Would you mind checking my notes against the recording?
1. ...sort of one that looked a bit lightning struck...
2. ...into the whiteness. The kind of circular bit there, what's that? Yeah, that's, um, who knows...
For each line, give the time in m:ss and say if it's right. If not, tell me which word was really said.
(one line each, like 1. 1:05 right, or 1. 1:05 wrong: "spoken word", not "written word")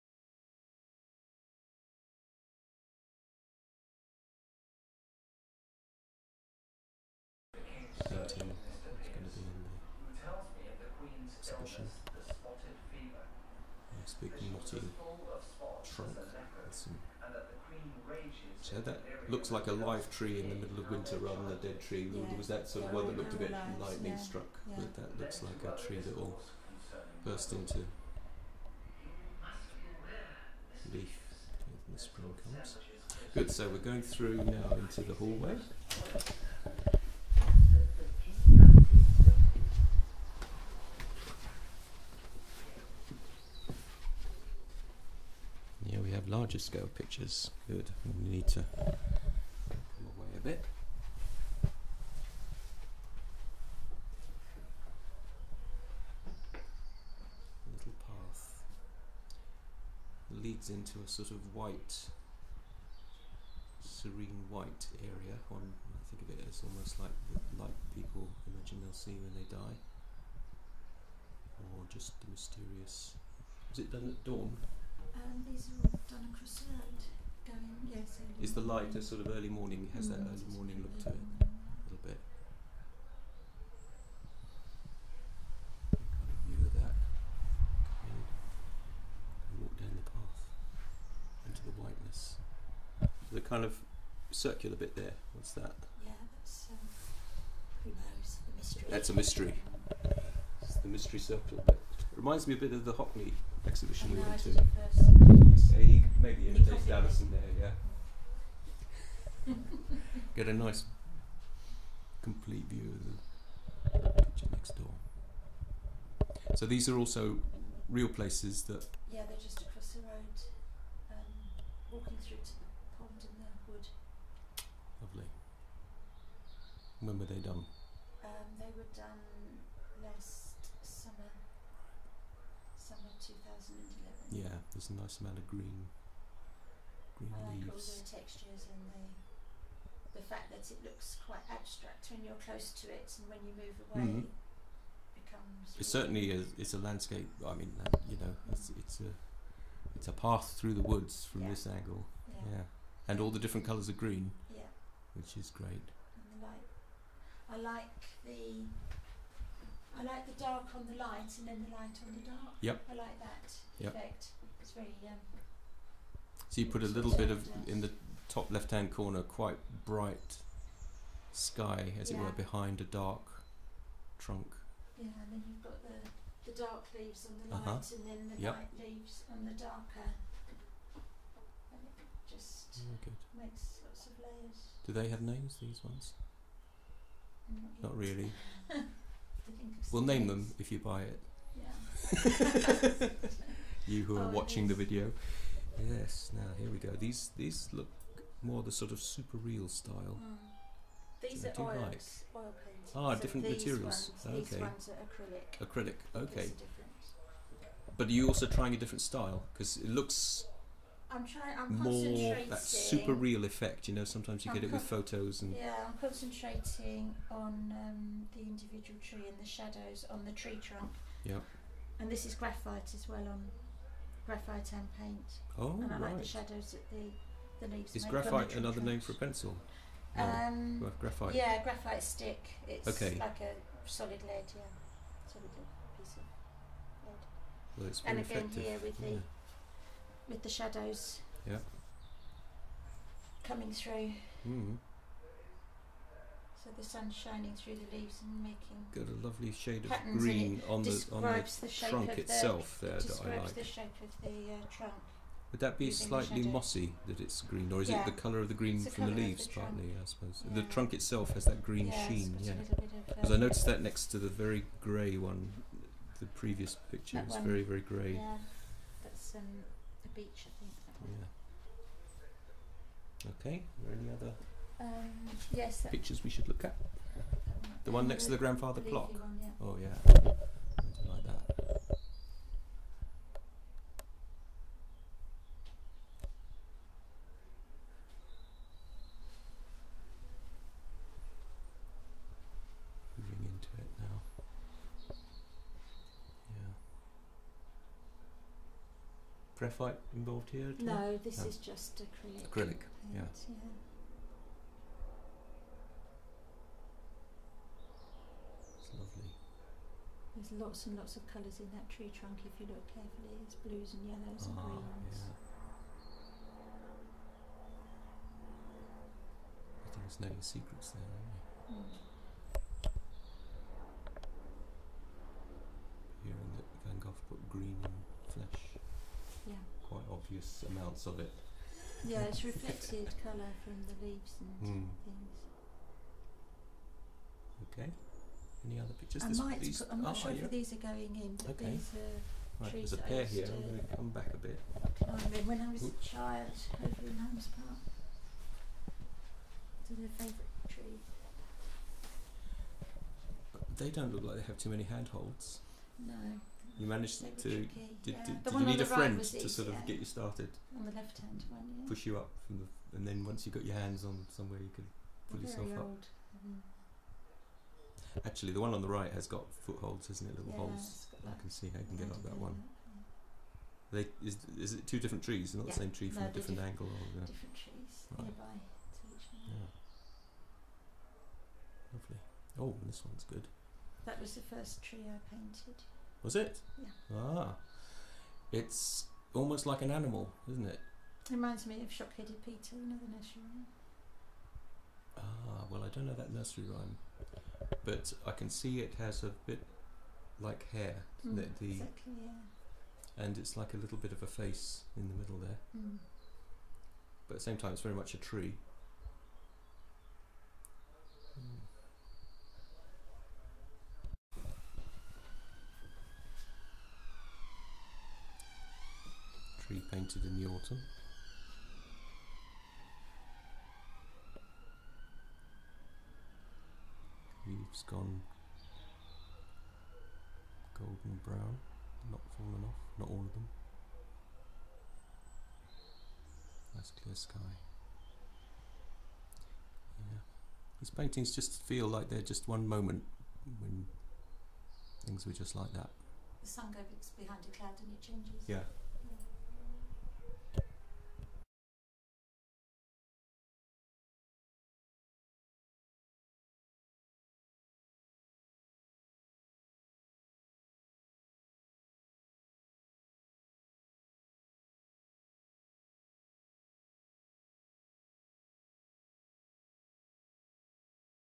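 1. 0:22 right
2. 1:31 right.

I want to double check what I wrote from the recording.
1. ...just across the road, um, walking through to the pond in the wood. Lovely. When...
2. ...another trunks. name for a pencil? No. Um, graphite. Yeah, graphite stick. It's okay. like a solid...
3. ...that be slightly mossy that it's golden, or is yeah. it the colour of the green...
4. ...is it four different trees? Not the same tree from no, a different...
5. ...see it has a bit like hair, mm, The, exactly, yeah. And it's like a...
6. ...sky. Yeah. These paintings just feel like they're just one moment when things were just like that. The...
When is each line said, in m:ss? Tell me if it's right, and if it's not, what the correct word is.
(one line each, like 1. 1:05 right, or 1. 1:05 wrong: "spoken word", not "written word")
1. 1:59 right
2. 3:48 right
3. 4:15 wrong: "green", not "golden"
4. 6:14 wrong: "two", not "four"
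5. 6:38 right
6. 7:17 right.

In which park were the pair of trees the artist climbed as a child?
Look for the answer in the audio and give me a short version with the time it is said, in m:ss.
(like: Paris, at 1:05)
Holmes Park, at 5:47.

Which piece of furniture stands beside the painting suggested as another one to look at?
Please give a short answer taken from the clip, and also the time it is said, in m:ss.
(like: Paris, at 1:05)
Grandfather clock, at 4:38.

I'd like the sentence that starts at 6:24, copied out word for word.
That was the first tree I painted.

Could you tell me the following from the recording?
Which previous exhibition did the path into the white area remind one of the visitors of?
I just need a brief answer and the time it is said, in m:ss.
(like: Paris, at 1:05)
The Hockney exhibition, at 1:42.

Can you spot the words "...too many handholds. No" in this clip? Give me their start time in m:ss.
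5:54.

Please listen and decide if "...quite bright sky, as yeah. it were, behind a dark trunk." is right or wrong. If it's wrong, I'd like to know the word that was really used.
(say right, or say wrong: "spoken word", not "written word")
right.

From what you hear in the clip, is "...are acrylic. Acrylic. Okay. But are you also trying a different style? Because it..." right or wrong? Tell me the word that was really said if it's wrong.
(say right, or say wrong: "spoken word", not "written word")
right.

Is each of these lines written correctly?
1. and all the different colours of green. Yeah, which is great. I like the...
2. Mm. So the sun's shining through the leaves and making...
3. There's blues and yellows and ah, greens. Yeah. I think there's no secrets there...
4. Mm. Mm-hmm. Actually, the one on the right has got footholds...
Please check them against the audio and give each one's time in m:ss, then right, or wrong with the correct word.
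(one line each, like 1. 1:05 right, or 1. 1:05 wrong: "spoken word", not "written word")
1. 2:33 right
2. 4:04 right
3. 5:13 right
4. 6:06 right.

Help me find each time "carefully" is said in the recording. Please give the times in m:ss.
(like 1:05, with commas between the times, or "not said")
5:12.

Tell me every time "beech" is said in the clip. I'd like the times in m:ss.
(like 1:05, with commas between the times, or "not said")
4:30.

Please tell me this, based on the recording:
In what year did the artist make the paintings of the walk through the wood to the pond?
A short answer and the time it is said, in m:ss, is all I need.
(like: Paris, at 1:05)
2011, at 2:13.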